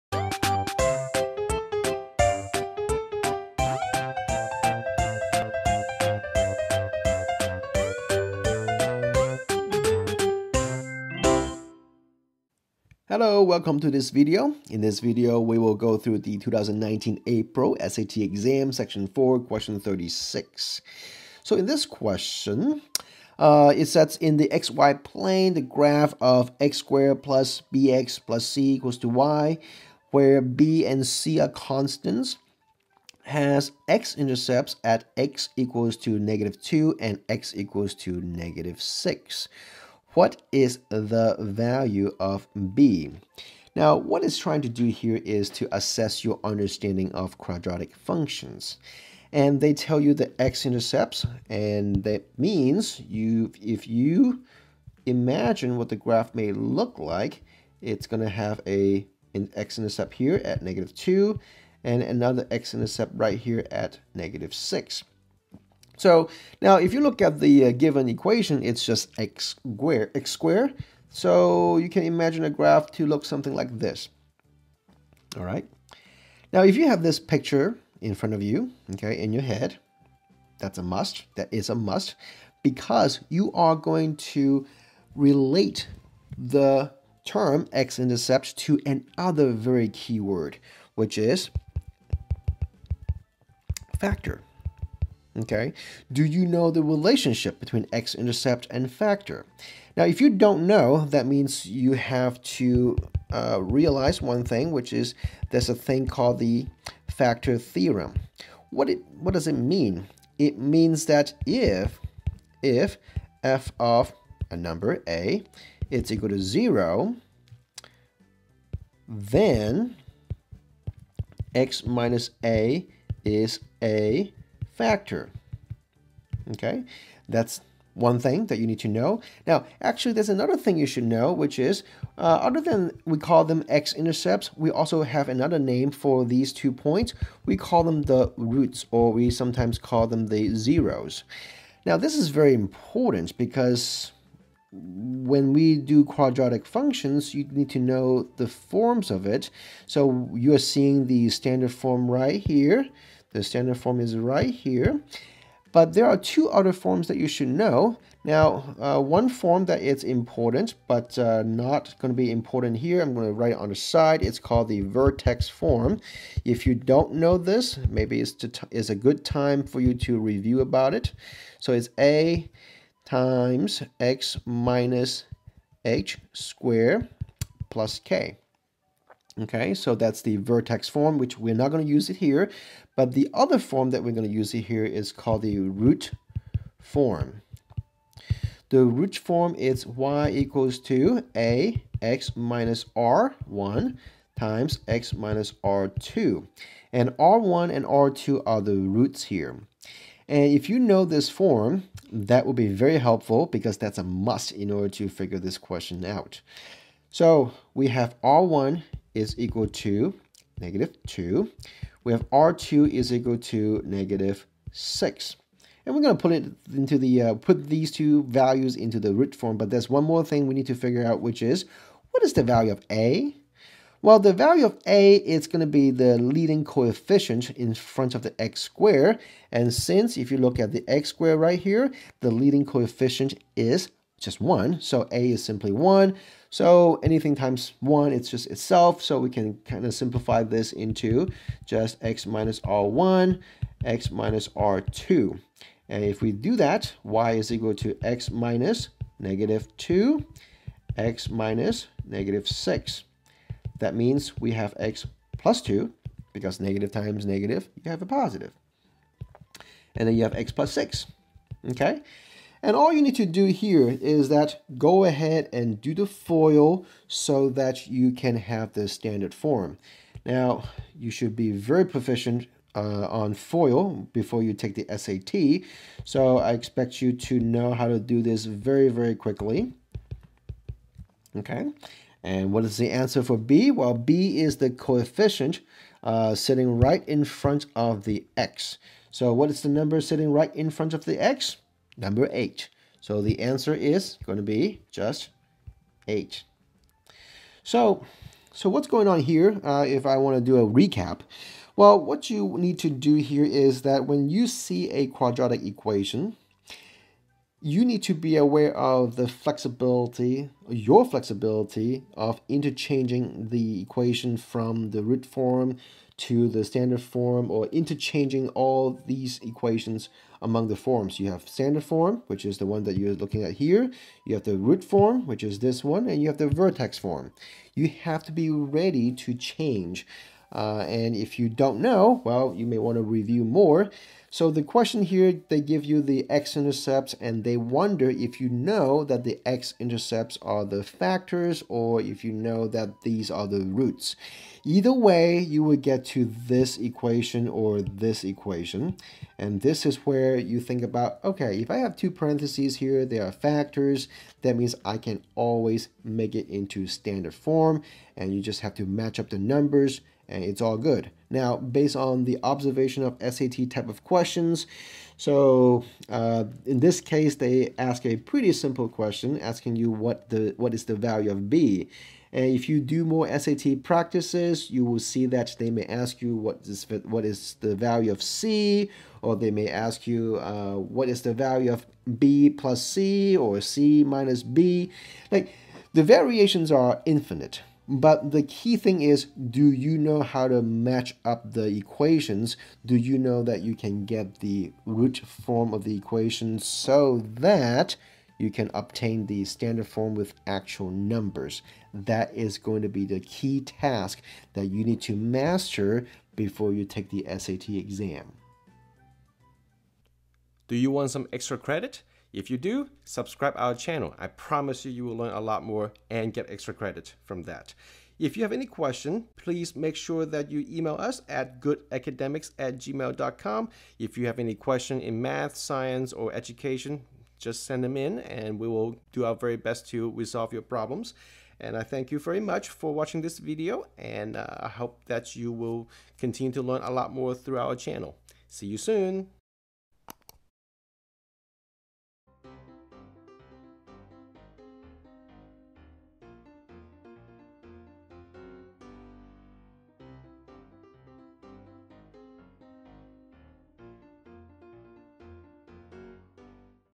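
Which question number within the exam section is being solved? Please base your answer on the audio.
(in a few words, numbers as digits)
36.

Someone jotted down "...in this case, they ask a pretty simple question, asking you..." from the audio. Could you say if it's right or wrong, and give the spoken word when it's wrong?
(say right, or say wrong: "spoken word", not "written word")
right.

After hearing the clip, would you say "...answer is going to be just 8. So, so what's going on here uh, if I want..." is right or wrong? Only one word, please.
right.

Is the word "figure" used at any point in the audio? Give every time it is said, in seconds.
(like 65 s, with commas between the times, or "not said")
205 s, 220 s.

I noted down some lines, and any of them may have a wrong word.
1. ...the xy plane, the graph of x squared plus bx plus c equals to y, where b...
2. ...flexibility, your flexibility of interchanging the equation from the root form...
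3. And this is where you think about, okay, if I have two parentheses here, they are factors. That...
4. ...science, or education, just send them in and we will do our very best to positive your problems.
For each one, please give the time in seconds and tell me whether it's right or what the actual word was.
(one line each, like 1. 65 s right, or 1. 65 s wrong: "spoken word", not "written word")
1. 24 s right
2. 309 s right
3. 349 s right
4. 425 s wrong: "resolve", not "positive".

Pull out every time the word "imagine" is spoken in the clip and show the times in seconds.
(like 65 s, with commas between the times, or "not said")
55 s, 72 s.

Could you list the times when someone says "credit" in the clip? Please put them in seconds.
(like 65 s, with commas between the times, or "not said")
411 s, 416 s.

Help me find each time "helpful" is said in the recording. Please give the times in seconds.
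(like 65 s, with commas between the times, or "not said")
202 s.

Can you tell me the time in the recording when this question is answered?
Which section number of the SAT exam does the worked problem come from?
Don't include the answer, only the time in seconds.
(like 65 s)
18 s.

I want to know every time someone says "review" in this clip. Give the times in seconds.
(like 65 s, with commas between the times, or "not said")
170 s, 333 s.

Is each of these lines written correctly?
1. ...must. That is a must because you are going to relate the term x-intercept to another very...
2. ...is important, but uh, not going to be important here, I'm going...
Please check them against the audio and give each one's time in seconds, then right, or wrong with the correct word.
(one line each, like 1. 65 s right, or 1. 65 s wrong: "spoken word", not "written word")
1. 80 s right
2. 159 s right.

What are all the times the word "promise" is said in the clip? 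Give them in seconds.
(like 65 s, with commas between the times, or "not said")
414 s.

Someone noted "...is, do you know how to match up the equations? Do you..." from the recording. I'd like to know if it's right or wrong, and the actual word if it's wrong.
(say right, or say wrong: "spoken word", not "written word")
right.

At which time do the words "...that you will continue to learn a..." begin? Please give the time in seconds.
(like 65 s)
435 s.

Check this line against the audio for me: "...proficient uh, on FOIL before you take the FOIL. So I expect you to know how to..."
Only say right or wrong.
wrong.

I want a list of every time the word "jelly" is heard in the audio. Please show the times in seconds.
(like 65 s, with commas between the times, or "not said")
not said.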